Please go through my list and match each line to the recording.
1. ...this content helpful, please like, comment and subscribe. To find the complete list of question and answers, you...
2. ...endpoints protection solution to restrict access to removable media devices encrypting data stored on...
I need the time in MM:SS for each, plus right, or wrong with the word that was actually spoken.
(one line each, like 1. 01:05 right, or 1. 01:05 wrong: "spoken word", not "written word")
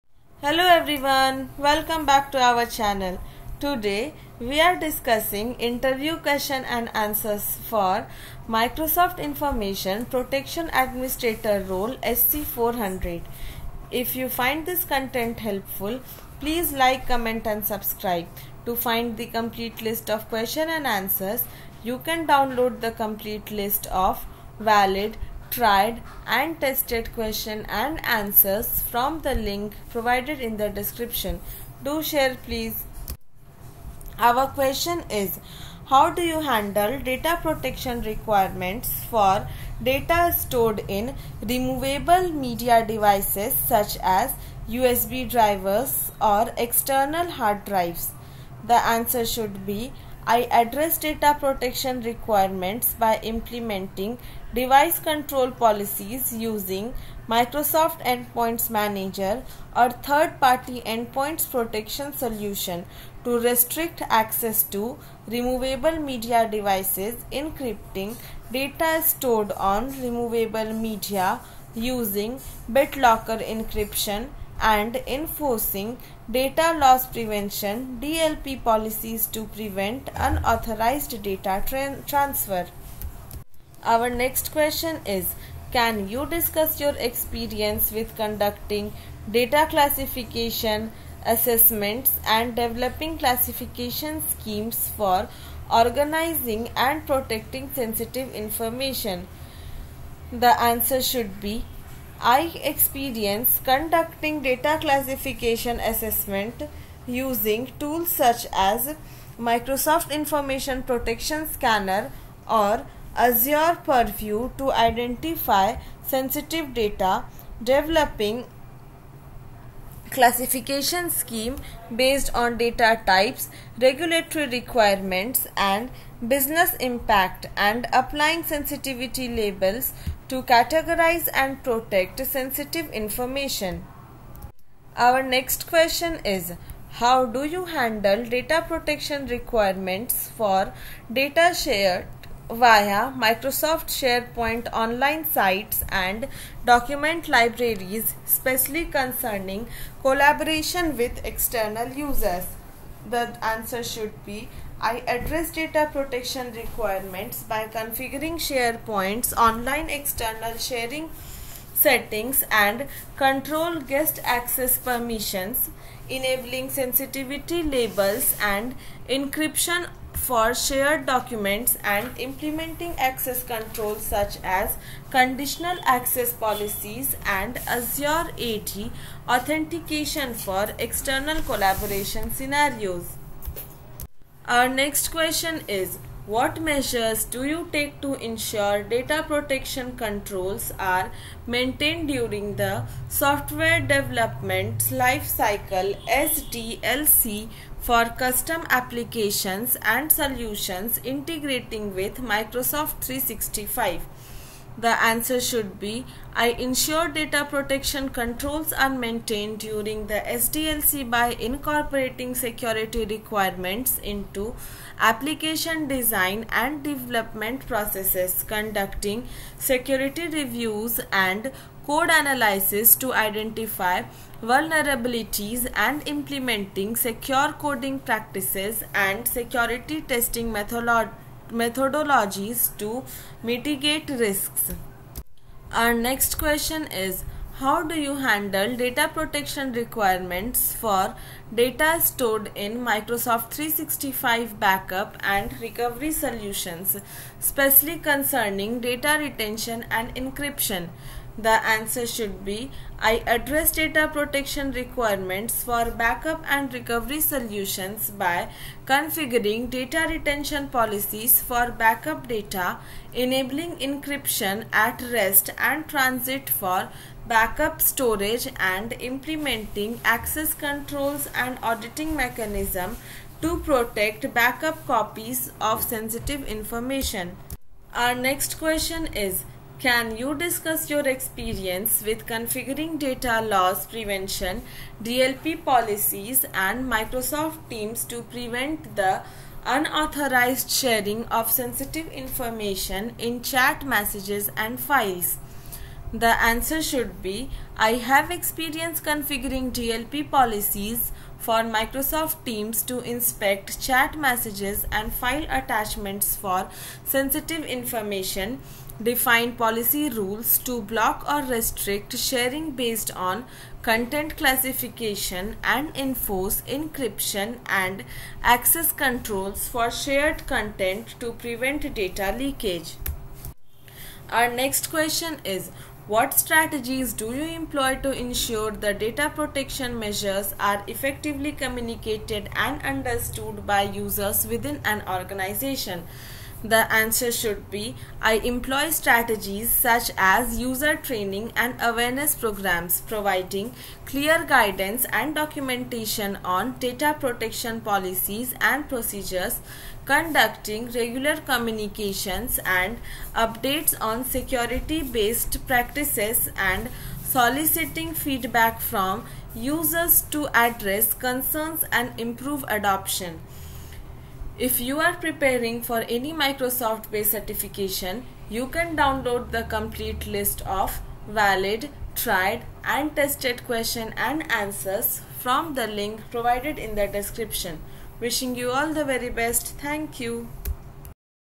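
1. 00:14 right
2. 01:00 right.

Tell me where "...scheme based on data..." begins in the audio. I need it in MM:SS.
02:01.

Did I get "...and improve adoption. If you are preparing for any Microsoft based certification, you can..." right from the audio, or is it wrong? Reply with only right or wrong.
right.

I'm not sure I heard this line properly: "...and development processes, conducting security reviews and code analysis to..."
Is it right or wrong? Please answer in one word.
right.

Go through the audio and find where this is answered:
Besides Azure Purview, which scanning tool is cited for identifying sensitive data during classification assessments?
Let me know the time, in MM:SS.
01:49.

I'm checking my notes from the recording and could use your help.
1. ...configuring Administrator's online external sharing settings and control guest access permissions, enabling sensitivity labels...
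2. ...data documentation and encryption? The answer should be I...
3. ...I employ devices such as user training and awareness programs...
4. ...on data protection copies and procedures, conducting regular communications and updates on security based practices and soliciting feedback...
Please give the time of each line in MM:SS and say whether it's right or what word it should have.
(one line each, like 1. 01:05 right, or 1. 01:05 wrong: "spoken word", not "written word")
1. 02:37 wrong: "SharePoint", not "Administrator"
2. 04:08 wrong: "retention", not "documentation"
3. 05:38 wrong: "strategies", not "devices"
4. 05:46 wrong: "policies", not "copies".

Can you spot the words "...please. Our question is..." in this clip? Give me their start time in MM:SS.
00:32.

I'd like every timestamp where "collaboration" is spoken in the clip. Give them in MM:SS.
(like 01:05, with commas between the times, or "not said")
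02:30, 03:01.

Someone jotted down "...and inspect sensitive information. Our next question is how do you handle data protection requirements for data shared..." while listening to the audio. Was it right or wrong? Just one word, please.
wrong.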